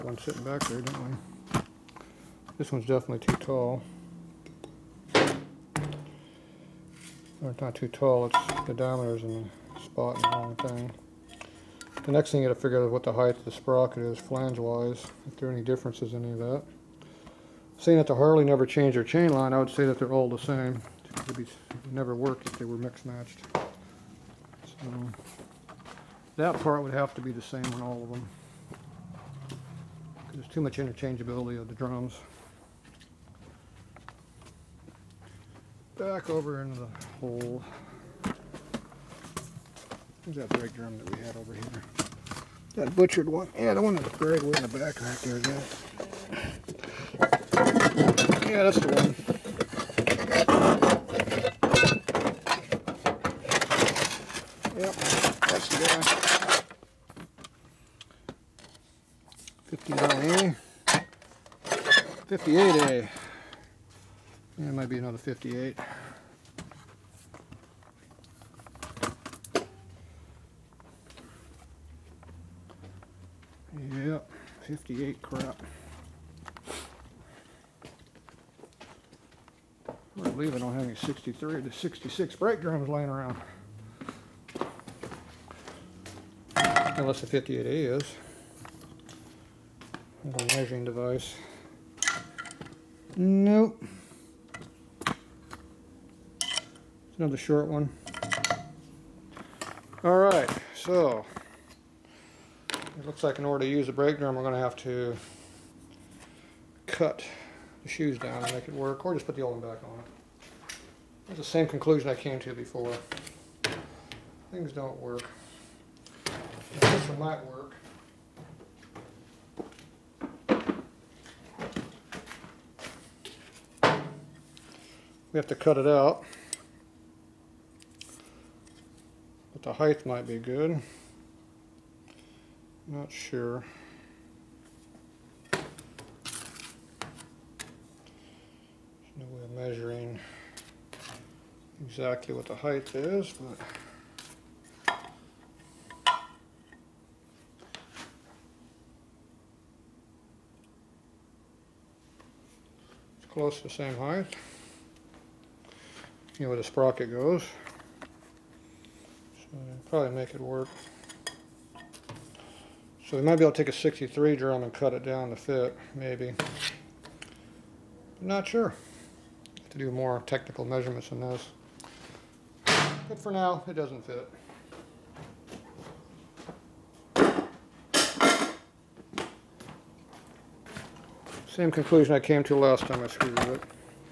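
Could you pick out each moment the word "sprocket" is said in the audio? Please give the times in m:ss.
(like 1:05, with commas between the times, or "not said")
0:13, 2:36.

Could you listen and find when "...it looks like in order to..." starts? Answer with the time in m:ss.
1:42.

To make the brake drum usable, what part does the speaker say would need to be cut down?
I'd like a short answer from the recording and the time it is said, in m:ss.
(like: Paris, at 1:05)
the shoes, at 1:47.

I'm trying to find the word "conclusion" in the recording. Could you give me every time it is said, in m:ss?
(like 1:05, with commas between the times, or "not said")
1:51, 3:01.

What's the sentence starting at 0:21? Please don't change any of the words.
It would never work if they were mixed matched.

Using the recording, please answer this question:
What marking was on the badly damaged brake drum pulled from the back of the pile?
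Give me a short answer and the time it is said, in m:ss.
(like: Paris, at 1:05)
59A, at 0:59.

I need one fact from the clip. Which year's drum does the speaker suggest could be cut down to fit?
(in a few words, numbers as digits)
63.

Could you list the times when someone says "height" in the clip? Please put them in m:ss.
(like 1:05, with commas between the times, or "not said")
0:13, 2:09, 2:22, 2:33.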